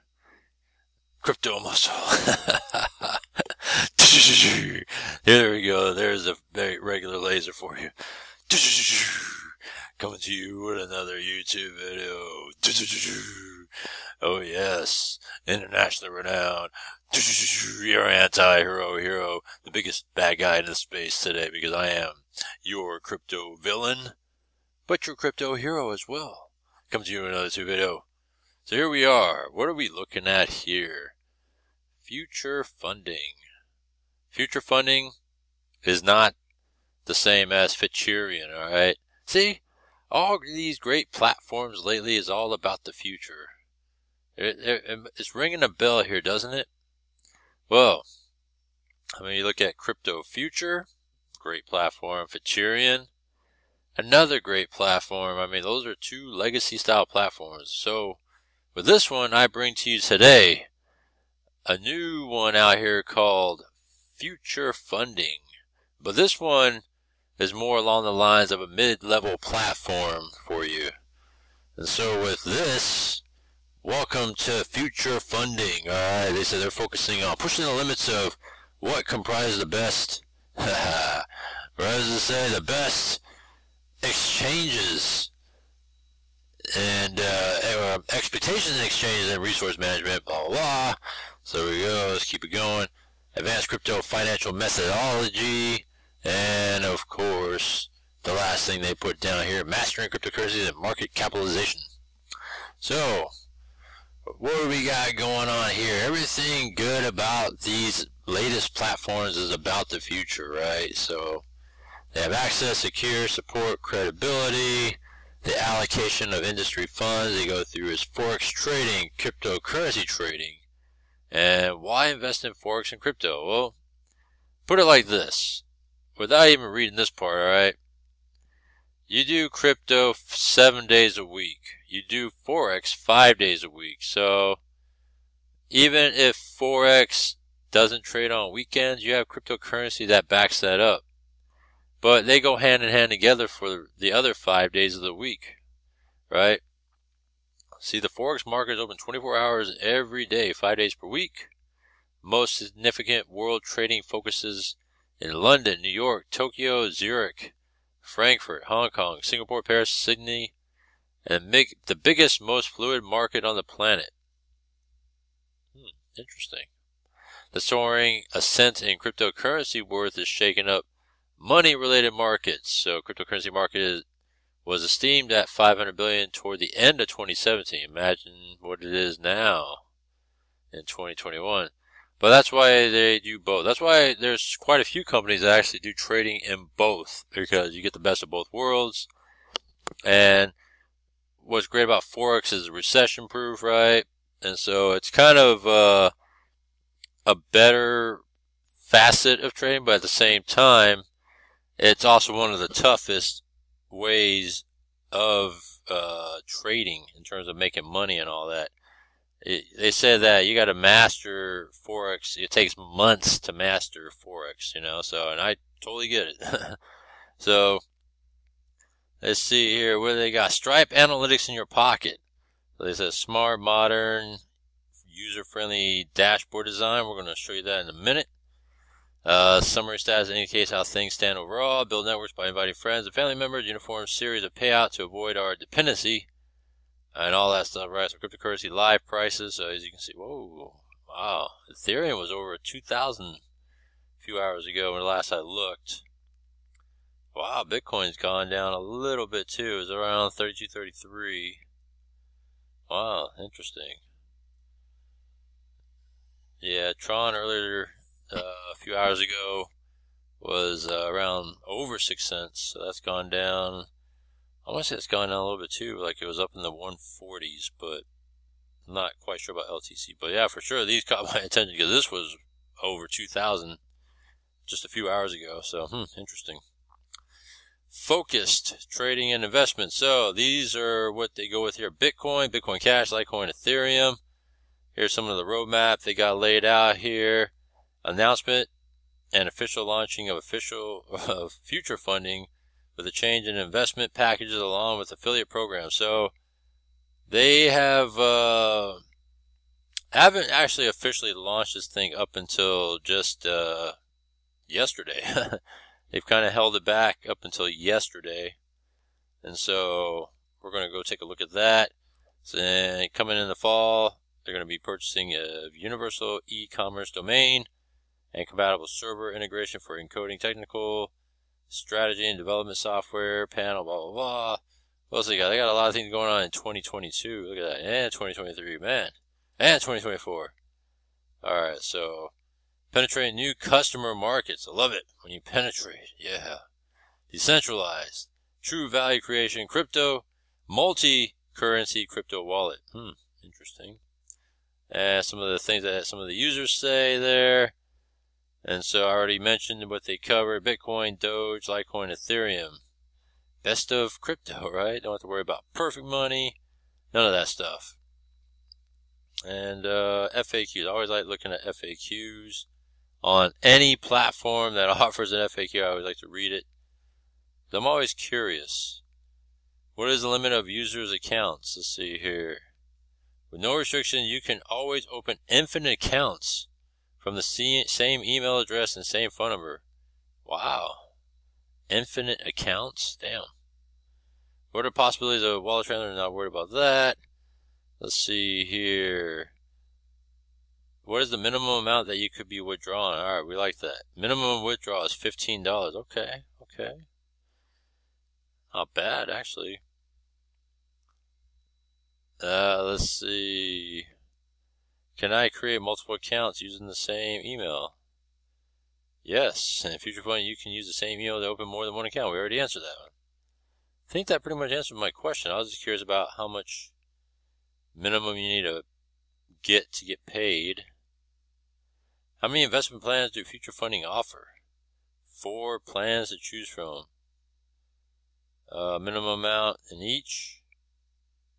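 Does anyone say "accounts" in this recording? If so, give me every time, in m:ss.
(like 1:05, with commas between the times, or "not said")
6:11, 6:15, 6:22, 6:46, 6:52.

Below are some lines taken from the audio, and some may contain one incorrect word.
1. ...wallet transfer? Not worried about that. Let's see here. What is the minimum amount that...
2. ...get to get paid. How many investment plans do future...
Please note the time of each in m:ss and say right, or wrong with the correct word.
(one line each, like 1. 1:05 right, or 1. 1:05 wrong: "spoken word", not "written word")
1. 6:25 right
2. 6:59 right.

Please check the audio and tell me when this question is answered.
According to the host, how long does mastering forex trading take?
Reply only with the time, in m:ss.
3:32.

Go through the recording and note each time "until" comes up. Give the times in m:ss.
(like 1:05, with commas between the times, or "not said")
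5:02, 5:07.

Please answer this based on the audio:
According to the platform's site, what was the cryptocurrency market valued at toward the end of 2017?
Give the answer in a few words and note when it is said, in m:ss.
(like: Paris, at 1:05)
500 billion, at 2:55.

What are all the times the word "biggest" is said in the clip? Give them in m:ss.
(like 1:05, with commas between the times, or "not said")
0:19, 2:41.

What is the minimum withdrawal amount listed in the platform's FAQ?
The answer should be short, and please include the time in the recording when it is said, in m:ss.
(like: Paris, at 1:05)
$15, at 6:35.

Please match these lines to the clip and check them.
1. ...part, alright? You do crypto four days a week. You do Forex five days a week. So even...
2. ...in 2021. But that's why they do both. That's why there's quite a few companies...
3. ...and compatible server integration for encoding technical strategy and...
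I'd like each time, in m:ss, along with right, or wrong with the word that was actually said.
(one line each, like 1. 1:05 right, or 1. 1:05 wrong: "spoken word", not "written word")
1. 2:07 wrong: "seven", not "four"
2. 3:00 right
3. 5:18 right.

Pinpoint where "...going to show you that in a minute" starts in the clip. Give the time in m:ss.
3:47.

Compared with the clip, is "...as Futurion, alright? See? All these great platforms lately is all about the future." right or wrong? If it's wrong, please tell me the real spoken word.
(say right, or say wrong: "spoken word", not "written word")
right.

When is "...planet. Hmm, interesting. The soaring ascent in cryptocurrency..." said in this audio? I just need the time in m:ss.
2:43.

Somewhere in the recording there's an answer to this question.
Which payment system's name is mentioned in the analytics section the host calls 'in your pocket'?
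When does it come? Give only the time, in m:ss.
3:40.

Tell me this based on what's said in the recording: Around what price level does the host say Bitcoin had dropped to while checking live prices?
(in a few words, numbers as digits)
32.33.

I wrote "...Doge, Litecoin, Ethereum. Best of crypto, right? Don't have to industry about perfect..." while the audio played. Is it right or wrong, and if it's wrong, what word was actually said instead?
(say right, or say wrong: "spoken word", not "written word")
wrong: "worry", not "industry".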